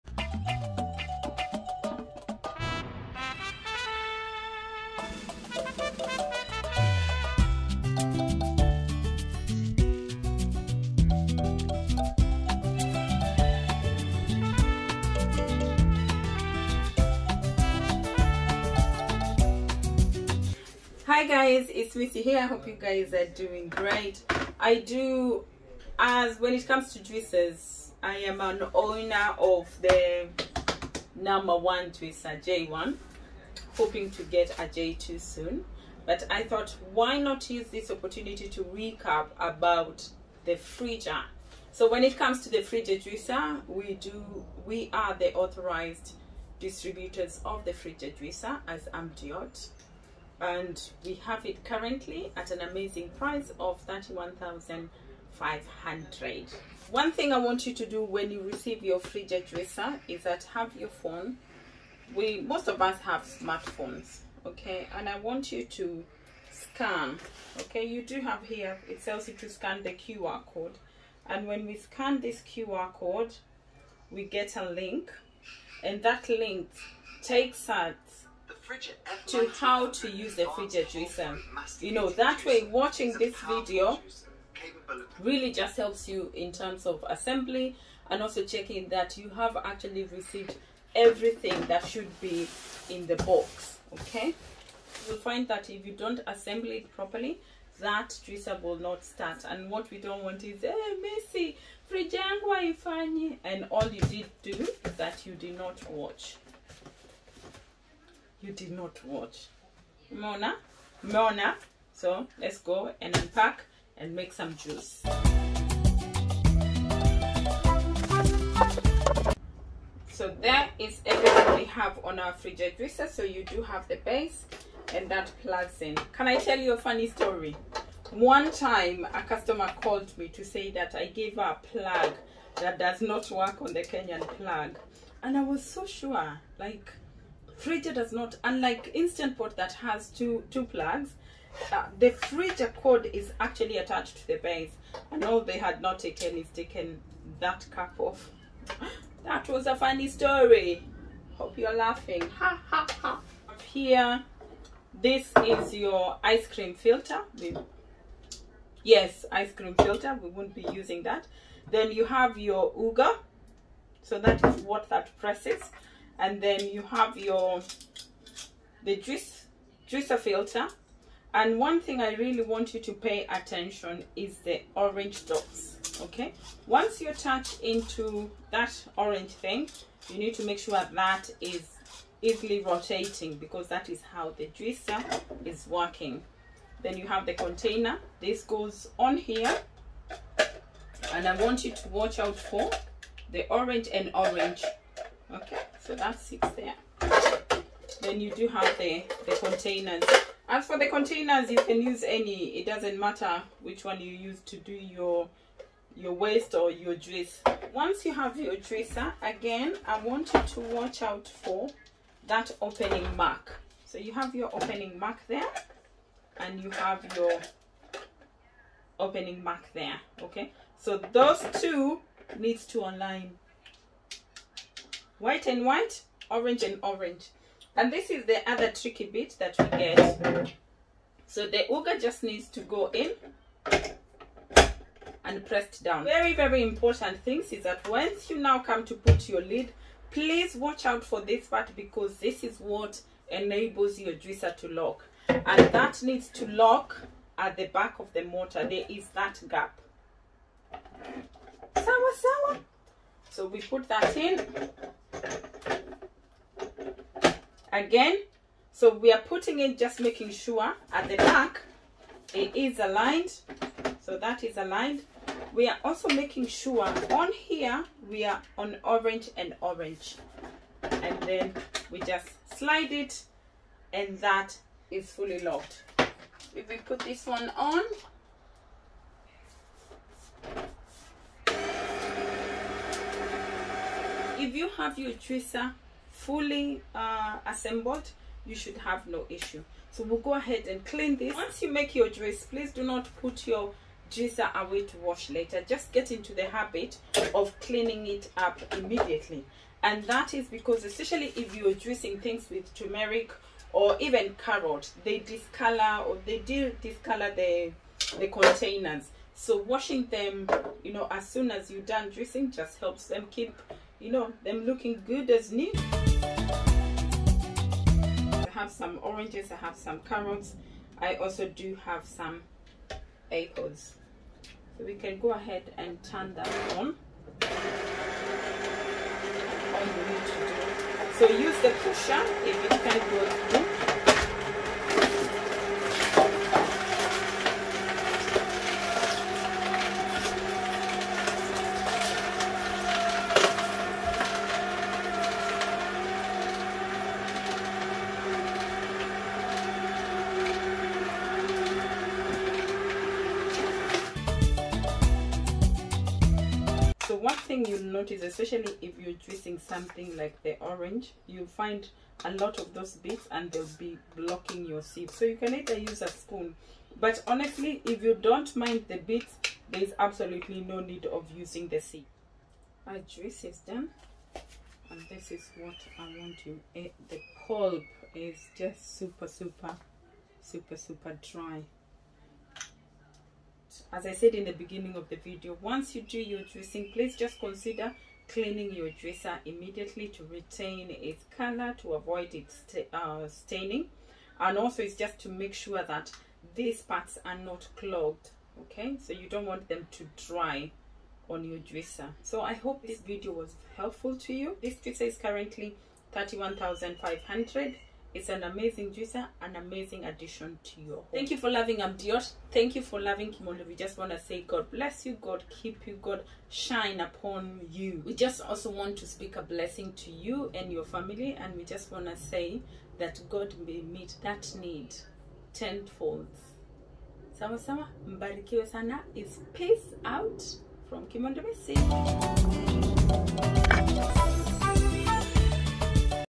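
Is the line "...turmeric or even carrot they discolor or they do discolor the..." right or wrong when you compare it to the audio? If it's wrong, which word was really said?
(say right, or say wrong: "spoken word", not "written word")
right.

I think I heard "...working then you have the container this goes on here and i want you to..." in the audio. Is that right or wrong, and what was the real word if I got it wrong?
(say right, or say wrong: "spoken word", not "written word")
right.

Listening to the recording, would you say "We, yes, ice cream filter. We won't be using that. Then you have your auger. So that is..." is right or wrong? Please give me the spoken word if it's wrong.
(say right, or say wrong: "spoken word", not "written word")
right.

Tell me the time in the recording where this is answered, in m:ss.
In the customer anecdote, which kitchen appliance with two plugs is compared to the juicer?
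2:18.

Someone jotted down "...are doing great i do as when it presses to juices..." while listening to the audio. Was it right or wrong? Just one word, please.
wrong.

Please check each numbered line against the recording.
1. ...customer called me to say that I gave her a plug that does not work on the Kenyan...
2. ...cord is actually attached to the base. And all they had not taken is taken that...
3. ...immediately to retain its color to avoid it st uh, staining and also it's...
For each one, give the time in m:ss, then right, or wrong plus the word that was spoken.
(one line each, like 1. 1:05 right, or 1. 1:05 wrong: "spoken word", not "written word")
1. 2:09 right
2. 2:22 right
3. 6:29 right.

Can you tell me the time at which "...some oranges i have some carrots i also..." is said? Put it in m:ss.
5:18.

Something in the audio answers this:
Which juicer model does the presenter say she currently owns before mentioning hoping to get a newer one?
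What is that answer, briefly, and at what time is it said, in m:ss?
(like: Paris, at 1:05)
Twister J1, at 0:31.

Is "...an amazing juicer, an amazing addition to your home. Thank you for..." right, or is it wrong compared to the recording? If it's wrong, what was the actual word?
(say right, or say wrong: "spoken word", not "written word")
right.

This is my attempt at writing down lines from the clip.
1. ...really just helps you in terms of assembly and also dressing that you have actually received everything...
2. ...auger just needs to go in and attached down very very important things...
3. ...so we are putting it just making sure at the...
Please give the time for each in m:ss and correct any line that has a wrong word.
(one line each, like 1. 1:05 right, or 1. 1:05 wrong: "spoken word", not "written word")
1. 1:25 wrong: "checking", not "dressing"
2. 3:51 wrong: "pressed", not "attached"
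3. 4:18 right.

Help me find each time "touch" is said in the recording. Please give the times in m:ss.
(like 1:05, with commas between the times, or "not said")
2:57.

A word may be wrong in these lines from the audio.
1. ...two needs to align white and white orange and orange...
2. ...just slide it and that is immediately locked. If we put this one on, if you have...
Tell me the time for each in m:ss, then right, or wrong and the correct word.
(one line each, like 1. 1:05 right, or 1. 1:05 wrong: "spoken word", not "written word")
1. 3:41 right
2. 4:32 wrong: "fully", not "immediately".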